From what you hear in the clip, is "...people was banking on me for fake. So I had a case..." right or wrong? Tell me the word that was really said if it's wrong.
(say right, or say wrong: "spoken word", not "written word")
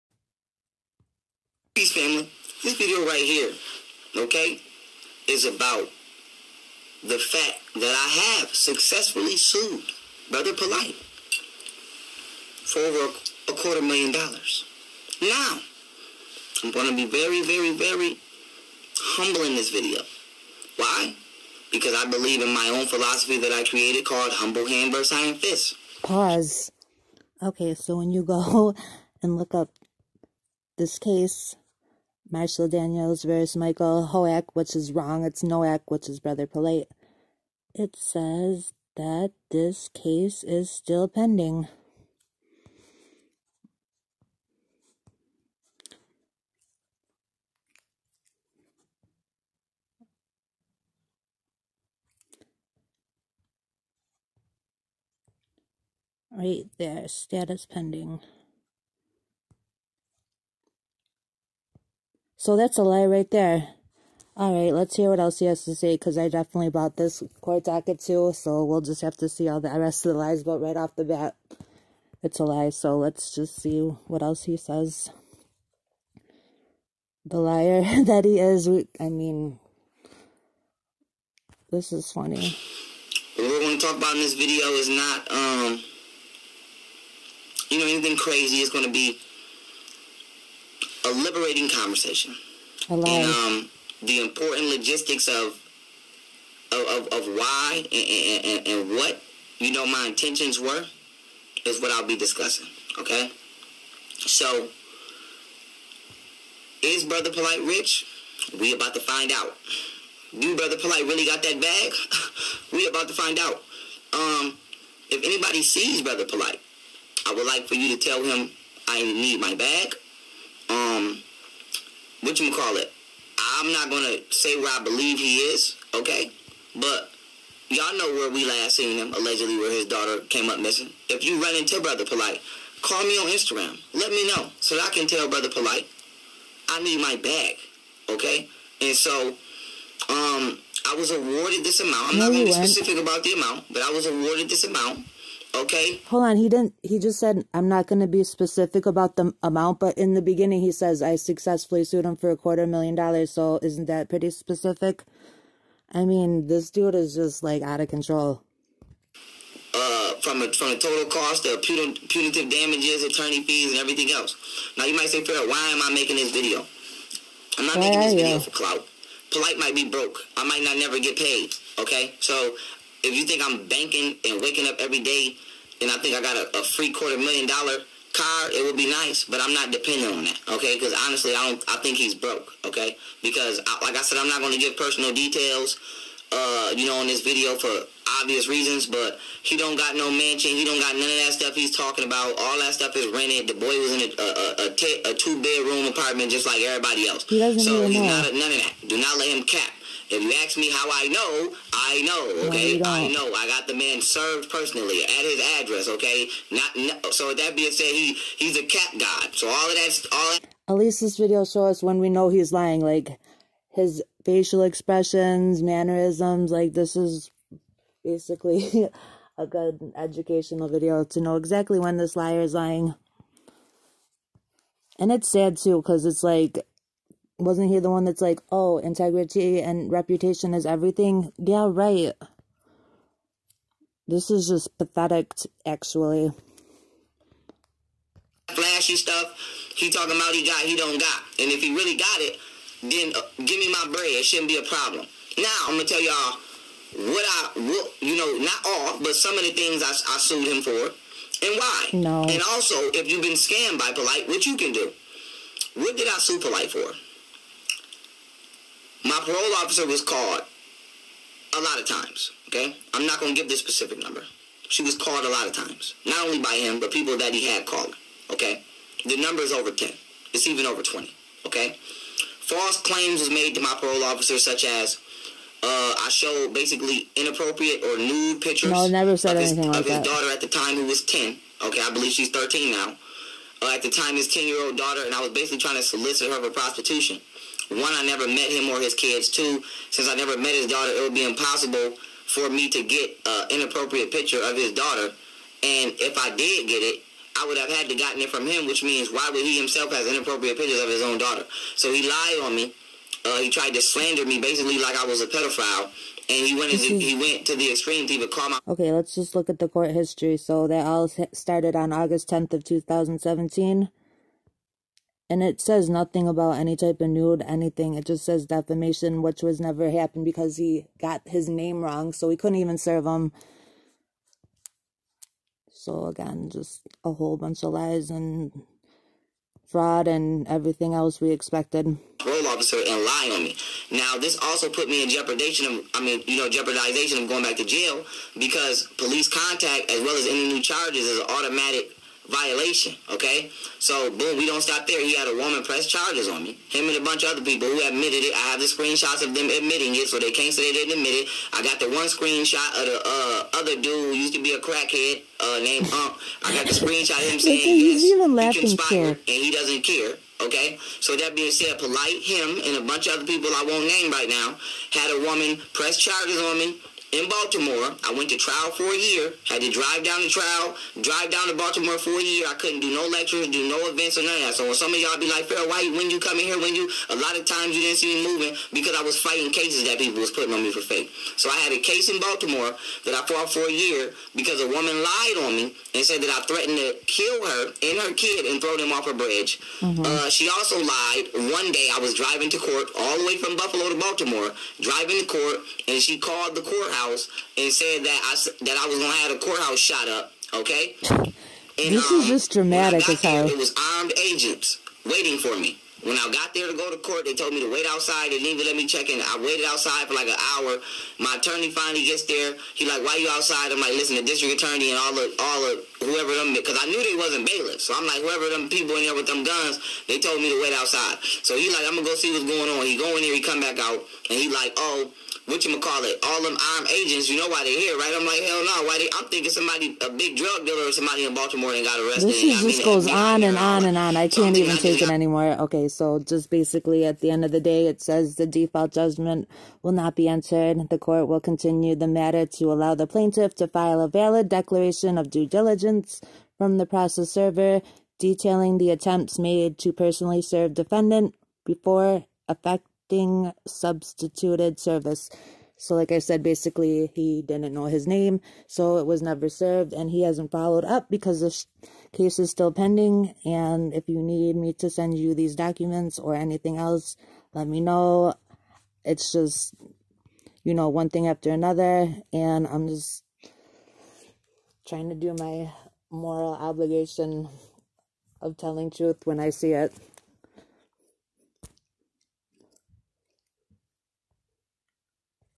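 wrong: "putting", not "banking".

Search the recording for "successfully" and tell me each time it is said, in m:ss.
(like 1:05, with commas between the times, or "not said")
0:08, 2:31.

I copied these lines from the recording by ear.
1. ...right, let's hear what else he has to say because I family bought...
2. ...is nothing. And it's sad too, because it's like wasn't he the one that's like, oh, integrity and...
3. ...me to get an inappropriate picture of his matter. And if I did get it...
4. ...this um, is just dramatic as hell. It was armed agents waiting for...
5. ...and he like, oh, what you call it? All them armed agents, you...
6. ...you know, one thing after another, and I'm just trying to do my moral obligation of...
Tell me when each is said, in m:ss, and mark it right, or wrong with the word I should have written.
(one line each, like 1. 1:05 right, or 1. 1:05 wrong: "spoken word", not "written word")
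1. 1:04 wrong: "definitely", not "family"
2. 3:42 wrong: "lying", not "nothing"
3. 4:52 wrong: "daughter", not "matter"
4. 6:41 right
5. 7:04 right
6. 7:50 right.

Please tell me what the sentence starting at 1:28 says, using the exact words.
It's going to be a liberating conversation.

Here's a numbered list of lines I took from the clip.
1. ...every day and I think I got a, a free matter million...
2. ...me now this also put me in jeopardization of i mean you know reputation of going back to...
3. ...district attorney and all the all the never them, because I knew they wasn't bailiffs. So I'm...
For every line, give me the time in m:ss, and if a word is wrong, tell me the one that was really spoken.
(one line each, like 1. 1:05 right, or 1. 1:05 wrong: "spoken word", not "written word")
1. 2:54 wrong: "quarter", not "matter"
2. 5:33 wrong: "jeopardization", not "reputation"
3. 6:54 wrong: "whoever", not "never".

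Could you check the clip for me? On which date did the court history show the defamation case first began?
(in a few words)
August 10th, 2017.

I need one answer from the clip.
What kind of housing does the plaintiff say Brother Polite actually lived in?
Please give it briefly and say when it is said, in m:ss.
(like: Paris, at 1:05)
A two bedroom apartment, at 3:15.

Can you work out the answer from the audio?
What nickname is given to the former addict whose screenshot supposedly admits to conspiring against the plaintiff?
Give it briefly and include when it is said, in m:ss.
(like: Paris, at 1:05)
Hump, at 5:55.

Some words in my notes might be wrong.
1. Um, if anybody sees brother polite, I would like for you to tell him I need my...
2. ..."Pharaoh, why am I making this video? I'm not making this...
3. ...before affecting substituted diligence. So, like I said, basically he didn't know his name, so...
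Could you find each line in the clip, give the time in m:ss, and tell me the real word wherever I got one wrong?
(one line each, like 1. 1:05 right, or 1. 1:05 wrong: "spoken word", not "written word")
1. 1:54 right
2. 2:45 right
3. 7:31 wrong: "service", not "diligence".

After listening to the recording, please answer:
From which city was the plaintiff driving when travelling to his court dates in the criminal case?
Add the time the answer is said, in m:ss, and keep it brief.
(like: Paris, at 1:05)
Buffalo, at 6:33.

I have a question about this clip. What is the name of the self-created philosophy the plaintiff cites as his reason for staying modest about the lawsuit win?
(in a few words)
Humble Hand versus Iron Fist.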